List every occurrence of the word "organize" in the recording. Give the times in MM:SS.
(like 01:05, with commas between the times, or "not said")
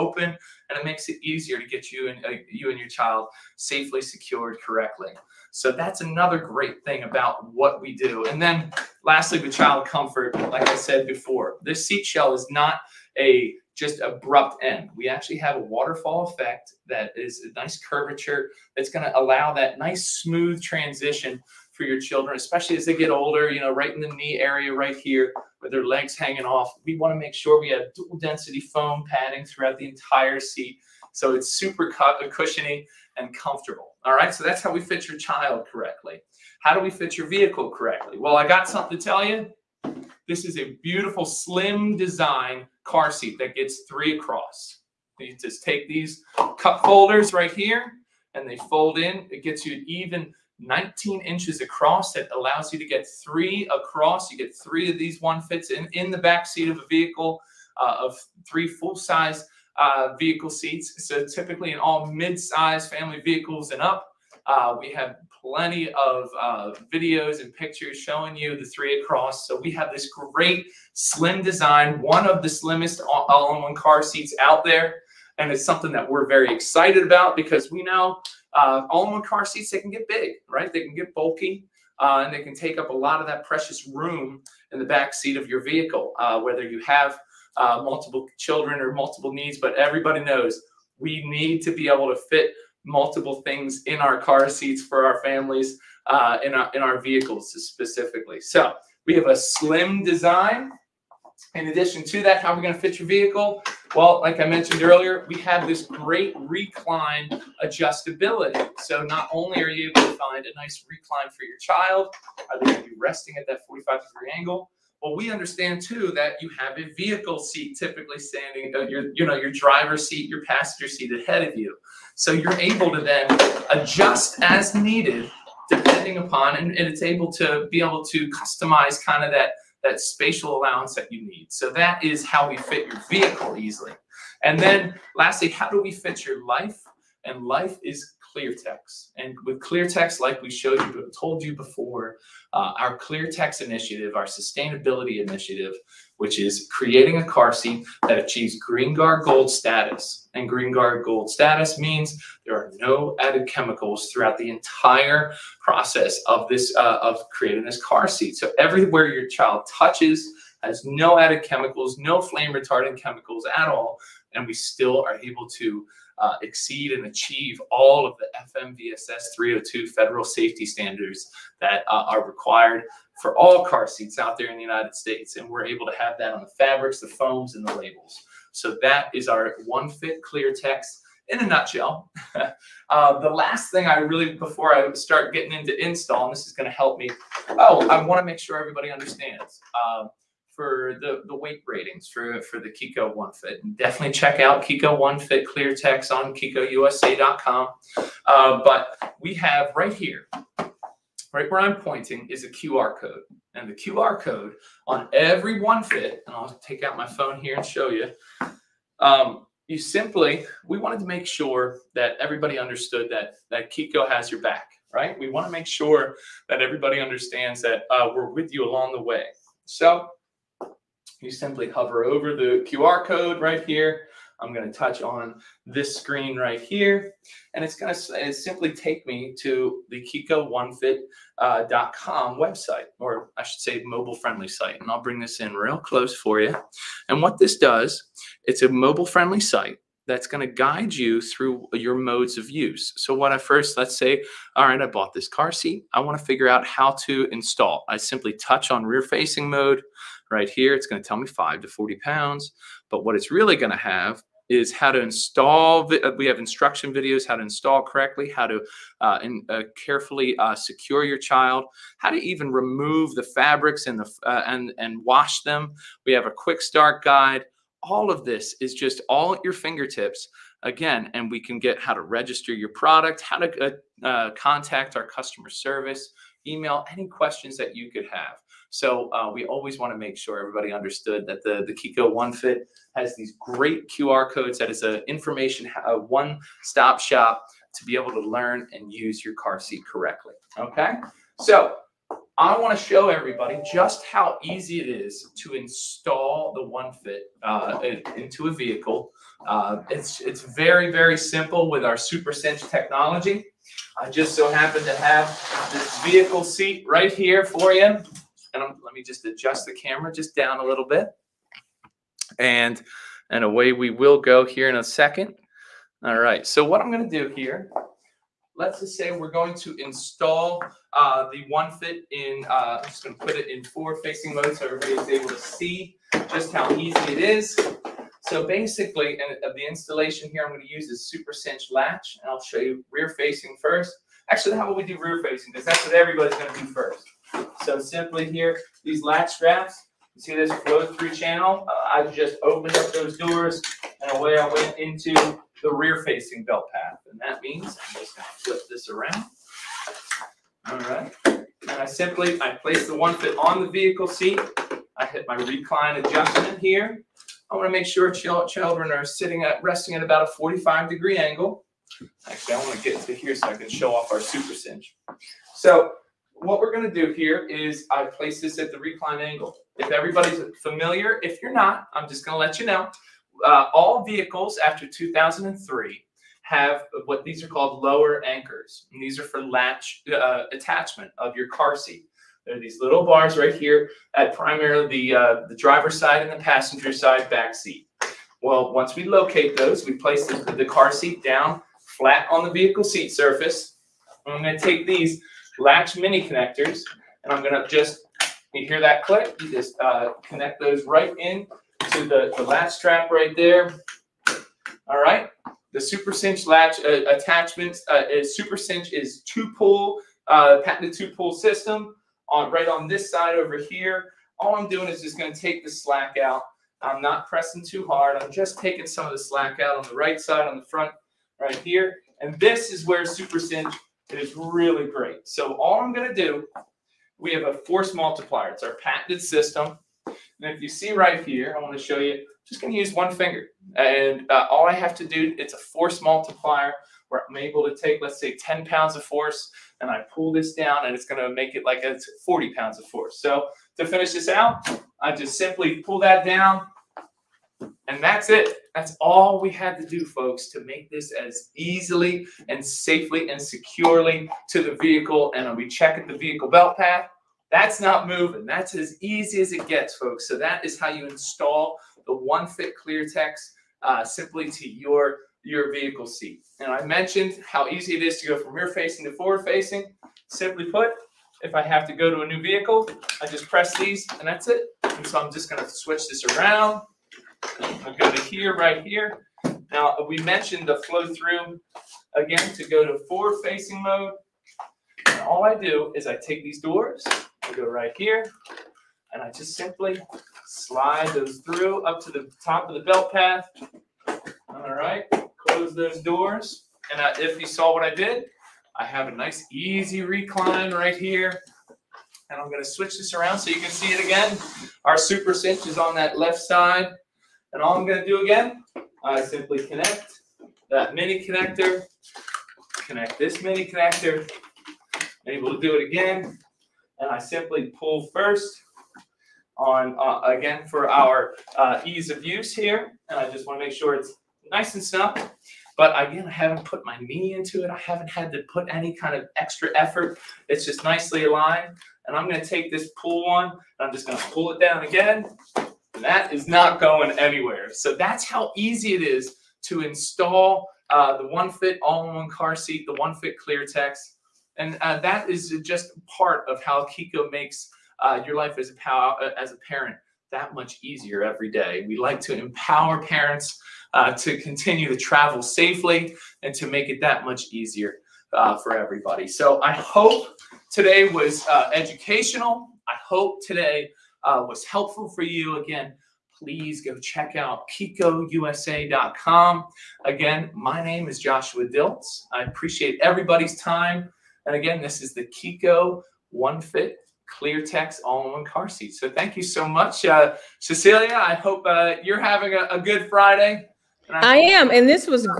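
not said.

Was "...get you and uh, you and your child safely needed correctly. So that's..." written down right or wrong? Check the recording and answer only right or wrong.
wrong.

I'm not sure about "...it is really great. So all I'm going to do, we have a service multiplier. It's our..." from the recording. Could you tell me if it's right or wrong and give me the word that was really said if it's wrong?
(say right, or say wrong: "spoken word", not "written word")
wrong: "force", not "service".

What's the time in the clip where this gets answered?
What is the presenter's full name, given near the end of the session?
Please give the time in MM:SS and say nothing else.
09:31.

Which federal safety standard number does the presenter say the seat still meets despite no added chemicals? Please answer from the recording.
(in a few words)
FMVSS 302.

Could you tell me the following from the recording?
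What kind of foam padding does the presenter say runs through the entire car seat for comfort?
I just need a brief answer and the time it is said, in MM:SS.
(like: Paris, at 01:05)
dual density, at 00:27.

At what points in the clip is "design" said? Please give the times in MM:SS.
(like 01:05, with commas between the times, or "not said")
00:41, 01:11, 01:40.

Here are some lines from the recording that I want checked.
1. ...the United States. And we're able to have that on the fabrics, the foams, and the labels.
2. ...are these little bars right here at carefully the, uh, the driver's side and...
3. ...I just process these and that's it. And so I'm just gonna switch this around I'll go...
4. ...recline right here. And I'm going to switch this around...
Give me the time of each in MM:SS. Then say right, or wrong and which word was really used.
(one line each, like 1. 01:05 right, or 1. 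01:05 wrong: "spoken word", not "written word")
1. 02:54 right
2. 06:22 wrong: "primarily", not "carefully"
3. 07:53 wrong: "press", not "process"
4. 08:20 right.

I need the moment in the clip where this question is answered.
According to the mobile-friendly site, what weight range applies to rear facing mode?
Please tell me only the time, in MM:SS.
04:11.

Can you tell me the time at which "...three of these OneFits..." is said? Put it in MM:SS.
00:54.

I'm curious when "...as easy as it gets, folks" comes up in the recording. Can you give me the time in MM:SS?
07:38.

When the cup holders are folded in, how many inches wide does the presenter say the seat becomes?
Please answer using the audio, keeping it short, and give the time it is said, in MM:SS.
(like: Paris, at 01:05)
19, at 00:50.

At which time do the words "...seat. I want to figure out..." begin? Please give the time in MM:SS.
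04:05.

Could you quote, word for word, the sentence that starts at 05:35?
Because that's what everybody's going to do first.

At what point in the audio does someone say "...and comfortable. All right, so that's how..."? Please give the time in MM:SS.
00:33.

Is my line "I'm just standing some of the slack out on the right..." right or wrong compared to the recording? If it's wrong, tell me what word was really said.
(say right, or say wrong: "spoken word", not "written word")
wrong: "taking", not "standing".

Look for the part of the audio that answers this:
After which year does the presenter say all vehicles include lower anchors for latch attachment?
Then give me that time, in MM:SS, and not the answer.
06:14.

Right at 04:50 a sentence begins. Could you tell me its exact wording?
Okay, so I want to show everybody just how easy it is to install the OneFit uh, into a vehicle.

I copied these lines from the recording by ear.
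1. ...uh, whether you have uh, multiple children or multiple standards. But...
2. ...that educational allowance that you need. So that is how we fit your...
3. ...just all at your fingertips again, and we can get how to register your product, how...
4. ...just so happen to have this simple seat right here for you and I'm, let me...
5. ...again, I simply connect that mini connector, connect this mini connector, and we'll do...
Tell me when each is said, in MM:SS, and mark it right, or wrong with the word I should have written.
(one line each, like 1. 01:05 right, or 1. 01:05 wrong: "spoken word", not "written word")
1. 01:26 wrong: "needs", not "standards"
2. 02:09 wrong: "spatial", not "educational"
3. 04:28 right
4. 05:04 wrong: "vehicle", not "simple"
5. 08:28 right.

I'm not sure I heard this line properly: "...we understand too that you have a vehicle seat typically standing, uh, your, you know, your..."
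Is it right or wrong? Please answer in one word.
right.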